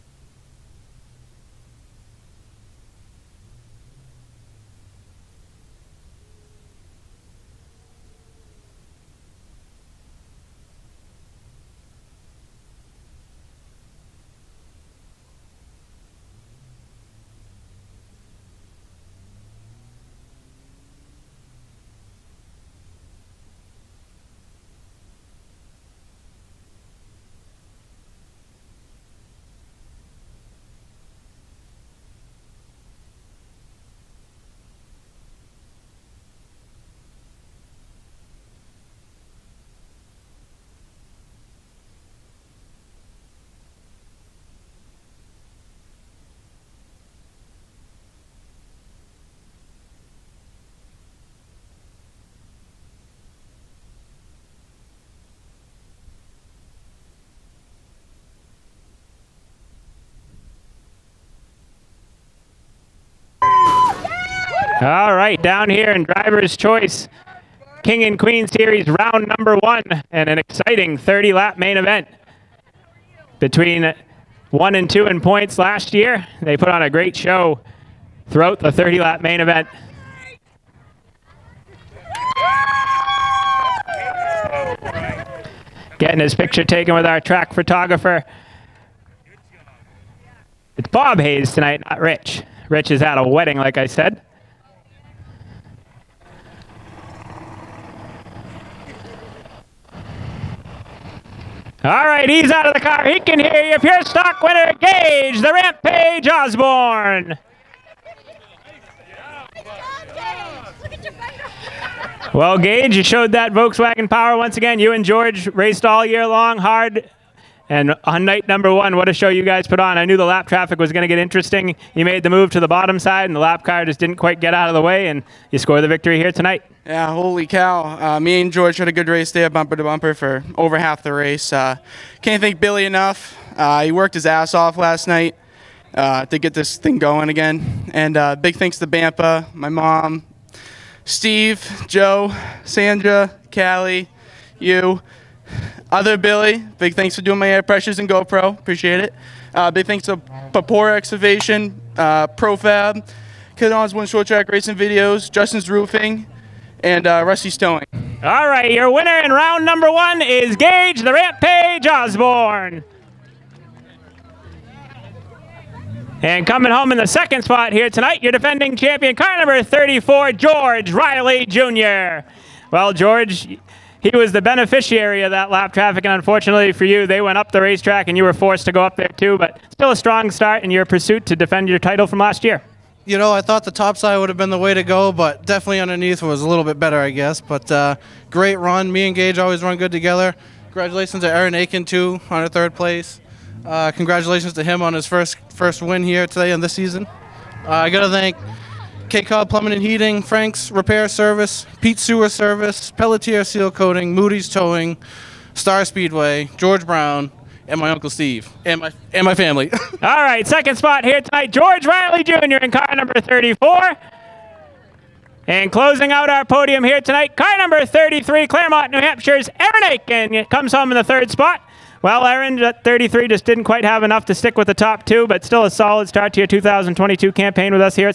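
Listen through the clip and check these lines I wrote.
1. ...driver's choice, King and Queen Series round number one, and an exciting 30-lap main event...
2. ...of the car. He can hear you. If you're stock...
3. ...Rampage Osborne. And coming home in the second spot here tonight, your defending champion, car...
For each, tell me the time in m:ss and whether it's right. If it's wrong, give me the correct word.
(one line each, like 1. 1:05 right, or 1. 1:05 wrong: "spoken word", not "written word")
1. 1:06 right
2. 1:42 right
3. 2:41 right.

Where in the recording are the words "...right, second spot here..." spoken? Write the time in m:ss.
3:30.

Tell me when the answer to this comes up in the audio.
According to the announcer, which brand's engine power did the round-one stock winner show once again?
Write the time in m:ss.
1:53.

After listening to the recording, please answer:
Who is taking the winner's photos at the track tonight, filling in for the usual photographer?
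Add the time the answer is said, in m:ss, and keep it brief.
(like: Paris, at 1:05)
Bob Hayes, at 1:30.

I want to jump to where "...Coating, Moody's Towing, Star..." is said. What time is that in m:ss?
3:23.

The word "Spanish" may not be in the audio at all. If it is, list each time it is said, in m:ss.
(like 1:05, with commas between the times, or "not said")
not said.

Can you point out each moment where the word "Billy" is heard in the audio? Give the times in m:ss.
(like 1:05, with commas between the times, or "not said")
2:12, 2:26.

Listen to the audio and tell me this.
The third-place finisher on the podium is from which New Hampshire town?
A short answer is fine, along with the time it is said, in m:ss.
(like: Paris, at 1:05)
Claremont, at 3:38.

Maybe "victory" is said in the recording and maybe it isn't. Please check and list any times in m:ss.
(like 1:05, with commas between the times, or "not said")
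2:05.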